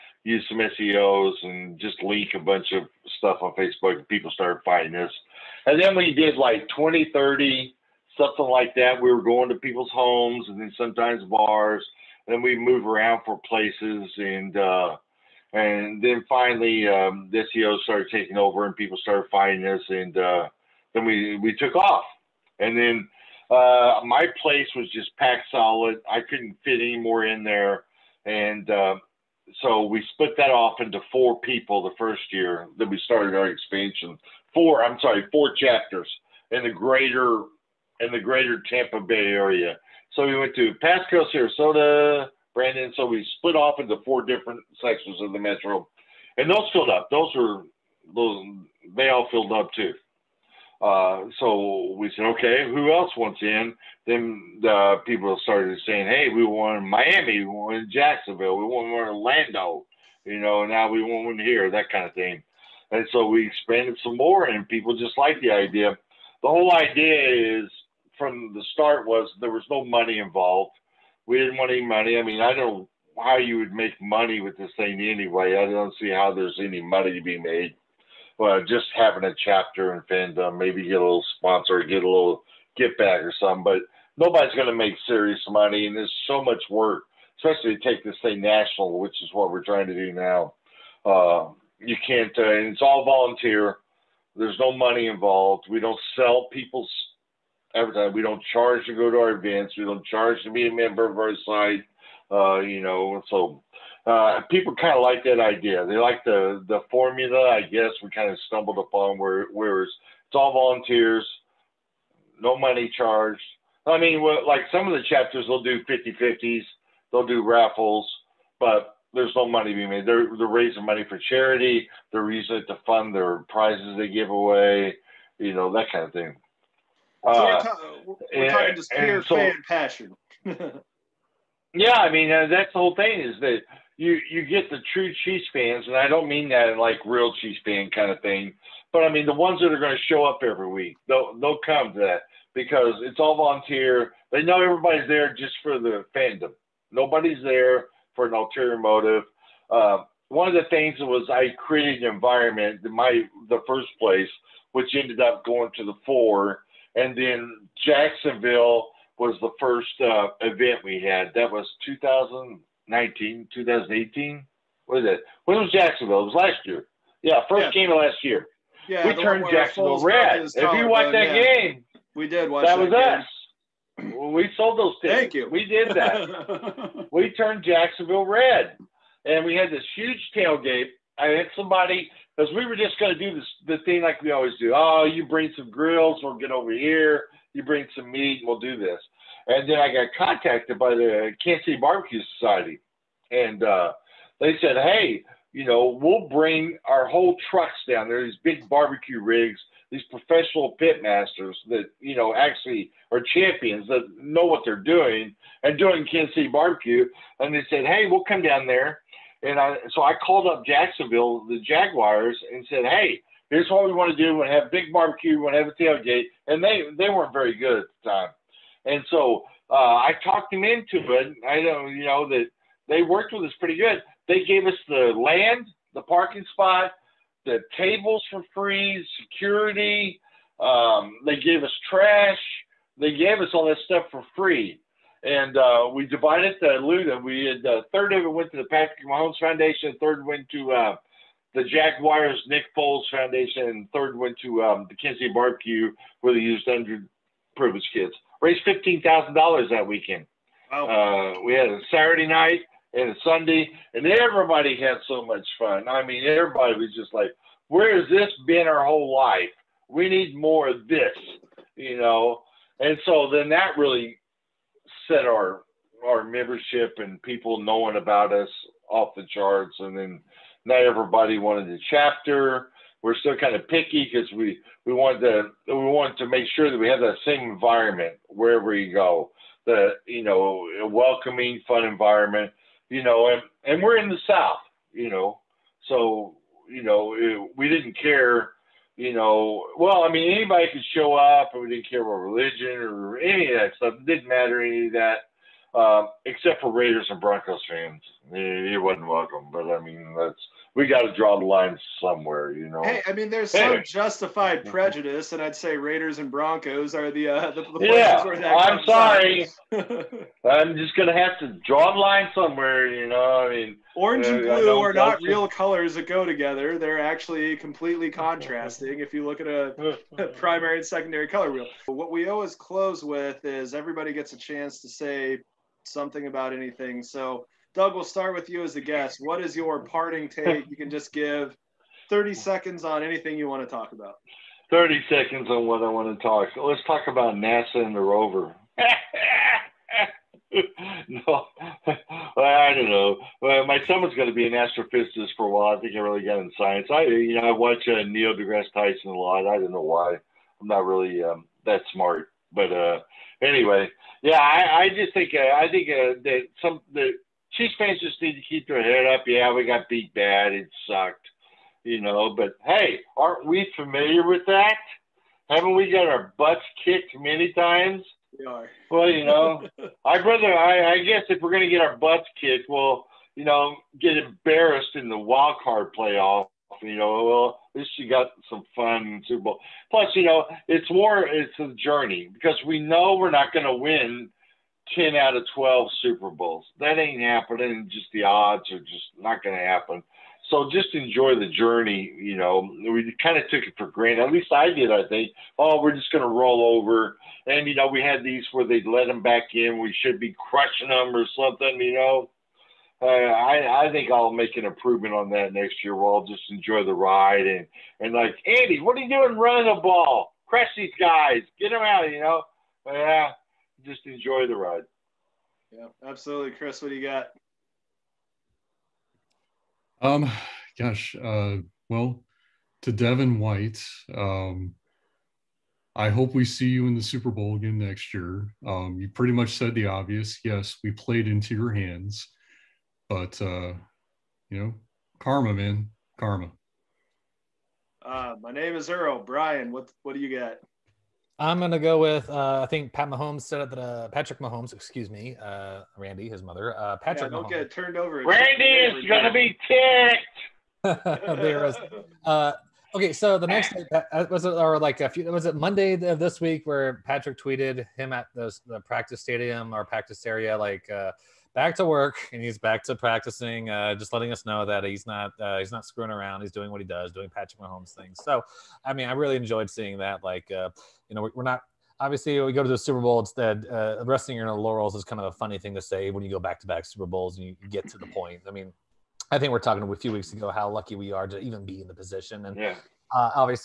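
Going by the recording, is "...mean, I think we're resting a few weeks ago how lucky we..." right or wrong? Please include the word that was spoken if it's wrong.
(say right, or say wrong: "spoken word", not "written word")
wrong: "talking", not "resting".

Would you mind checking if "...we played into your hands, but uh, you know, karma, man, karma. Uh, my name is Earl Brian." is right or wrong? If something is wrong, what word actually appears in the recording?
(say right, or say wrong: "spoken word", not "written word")
right.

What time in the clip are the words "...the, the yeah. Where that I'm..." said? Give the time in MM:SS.
05:07.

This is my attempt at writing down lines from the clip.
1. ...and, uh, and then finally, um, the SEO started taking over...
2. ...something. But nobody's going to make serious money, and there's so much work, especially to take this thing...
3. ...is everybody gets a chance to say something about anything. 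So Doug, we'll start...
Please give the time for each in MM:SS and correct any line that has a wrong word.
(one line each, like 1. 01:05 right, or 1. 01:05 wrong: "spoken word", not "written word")
1. 00:14 right
2. 01:23 right
3. 05:23 right.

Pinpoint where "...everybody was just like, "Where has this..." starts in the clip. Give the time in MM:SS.
04:16.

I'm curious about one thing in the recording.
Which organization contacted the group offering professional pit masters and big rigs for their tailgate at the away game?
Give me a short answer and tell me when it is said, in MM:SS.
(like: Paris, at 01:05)
Kansas City Barbecue Society, at 03:11.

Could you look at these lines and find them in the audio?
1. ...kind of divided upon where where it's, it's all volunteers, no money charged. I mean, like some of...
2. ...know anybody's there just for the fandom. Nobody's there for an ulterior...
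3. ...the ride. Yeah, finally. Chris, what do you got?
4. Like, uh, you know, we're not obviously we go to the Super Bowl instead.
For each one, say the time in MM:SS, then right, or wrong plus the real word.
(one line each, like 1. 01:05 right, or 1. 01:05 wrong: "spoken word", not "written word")
1. 01:48 wrong: "stumbled", not "divided"
2. 02:24 wrong: "everybody", not "anybody"
3. 06:54 wrong: "absolutely", not "finally"
4. 07:50 right.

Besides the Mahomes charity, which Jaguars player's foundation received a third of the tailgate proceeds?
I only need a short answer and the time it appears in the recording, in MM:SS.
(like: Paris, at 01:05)
Nick Foles, at 04:02.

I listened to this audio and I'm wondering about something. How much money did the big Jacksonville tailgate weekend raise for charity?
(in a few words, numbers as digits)
$15,000.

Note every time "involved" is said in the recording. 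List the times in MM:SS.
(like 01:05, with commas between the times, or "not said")
01:10, 01:35.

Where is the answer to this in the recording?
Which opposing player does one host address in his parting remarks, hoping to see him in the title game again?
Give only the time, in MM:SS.
07:02.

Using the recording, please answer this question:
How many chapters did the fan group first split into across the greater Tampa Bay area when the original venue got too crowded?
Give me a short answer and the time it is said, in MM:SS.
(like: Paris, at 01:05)
4, at 00:35.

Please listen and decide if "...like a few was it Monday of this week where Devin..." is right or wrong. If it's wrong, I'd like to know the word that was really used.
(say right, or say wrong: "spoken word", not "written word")
wrong: "Patrick", not "Devin".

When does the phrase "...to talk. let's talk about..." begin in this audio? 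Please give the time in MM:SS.
05:36.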